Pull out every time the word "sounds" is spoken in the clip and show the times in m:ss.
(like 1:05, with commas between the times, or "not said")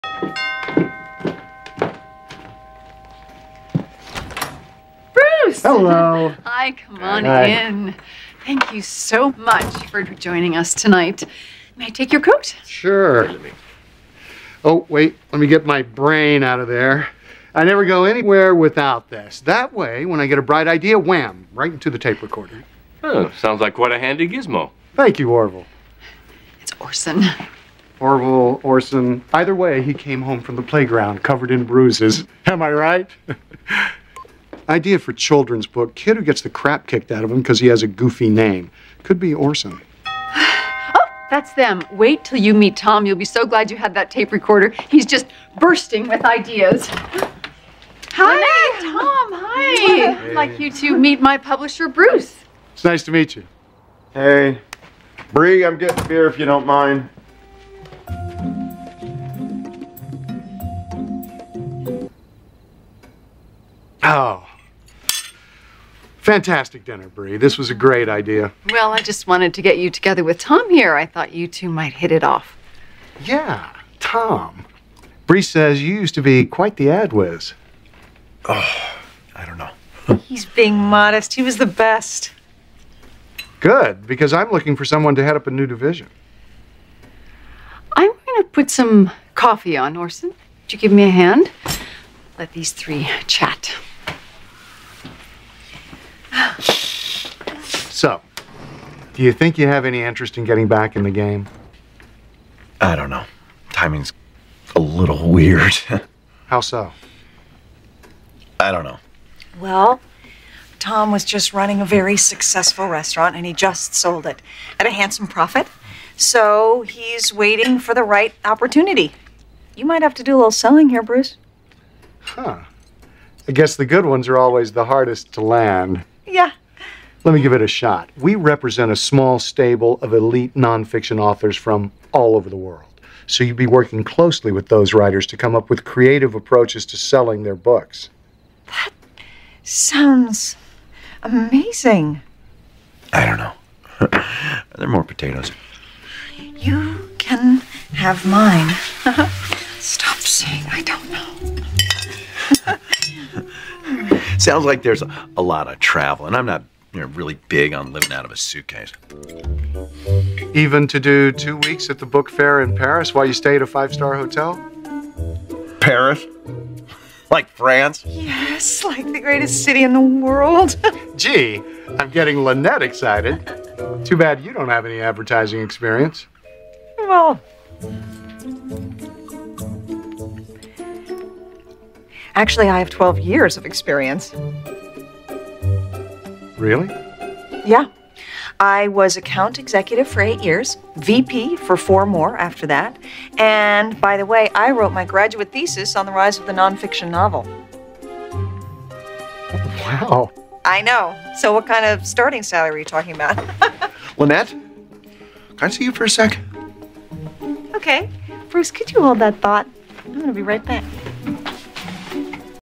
0:23, 2:19, 2:34.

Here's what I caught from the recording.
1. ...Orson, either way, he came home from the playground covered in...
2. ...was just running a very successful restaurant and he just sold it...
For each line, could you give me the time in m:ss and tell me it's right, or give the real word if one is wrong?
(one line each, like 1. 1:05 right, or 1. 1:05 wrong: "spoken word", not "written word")
1. 0:28 right
2. 1:51 right.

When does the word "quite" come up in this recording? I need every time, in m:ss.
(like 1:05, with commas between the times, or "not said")
0:23, 1:16.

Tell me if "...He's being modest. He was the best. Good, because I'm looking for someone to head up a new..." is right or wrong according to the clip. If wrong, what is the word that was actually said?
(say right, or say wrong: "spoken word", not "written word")
right.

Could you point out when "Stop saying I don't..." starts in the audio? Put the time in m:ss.
2:29.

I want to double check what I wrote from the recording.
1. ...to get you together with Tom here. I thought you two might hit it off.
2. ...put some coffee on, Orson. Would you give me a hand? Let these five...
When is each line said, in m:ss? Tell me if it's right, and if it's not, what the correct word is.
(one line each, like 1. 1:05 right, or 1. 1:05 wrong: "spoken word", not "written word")
1. 1:09 right
2. 1:28 wrong: "three", not "five".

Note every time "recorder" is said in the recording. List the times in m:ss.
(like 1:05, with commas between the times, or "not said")
0:22, 0:44.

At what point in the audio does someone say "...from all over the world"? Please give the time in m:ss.
2:11.